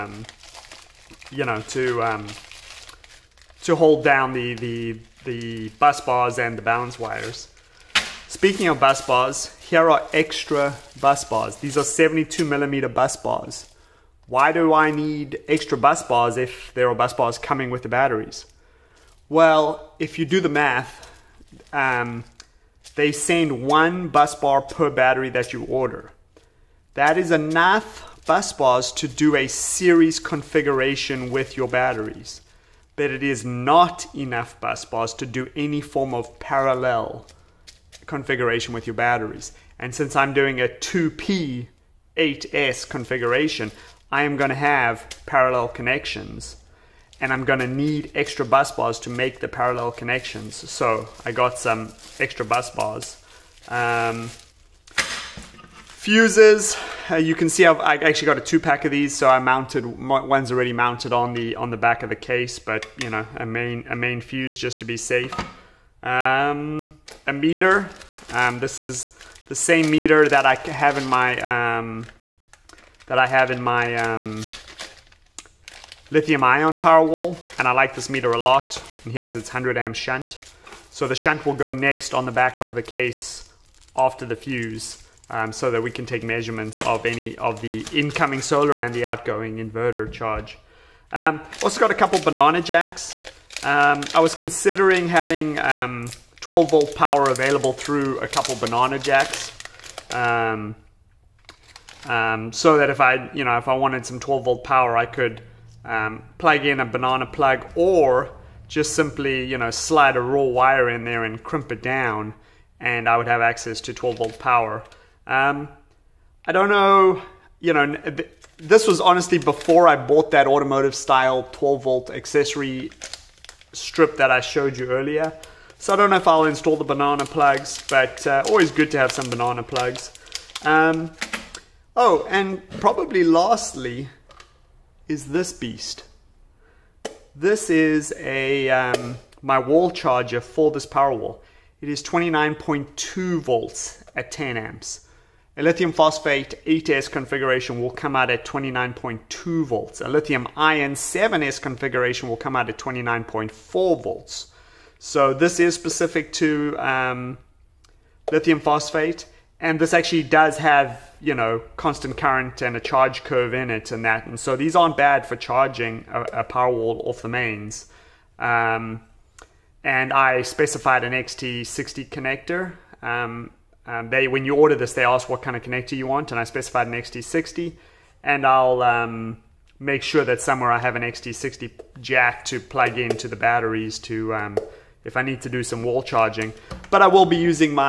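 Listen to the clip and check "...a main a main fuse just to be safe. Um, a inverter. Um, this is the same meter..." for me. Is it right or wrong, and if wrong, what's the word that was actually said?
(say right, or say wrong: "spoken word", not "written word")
wrong: "meter", not "inverter".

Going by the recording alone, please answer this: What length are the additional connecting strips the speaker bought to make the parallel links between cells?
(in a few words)
72 millimeter.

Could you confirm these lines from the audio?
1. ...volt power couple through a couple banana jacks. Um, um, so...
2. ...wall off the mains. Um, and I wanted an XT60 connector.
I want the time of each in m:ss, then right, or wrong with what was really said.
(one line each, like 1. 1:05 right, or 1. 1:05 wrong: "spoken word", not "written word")
1. 1:36 wrong: "available", not "couple"
2. 2:46 wrong: "specified", not "wanted".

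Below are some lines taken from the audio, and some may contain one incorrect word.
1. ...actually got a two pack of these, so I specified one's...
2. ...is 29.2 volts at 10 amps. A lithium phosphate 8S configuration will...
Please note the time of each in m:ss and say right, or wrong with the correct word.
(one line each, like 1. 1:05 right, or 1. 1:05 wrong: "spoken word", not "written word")
1. 0:57 wrong: "mounted", not "specified"
2. 2:21 right.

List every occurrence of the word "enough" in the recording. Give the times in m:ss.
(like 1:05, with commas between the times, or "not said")
0:27, 0:34.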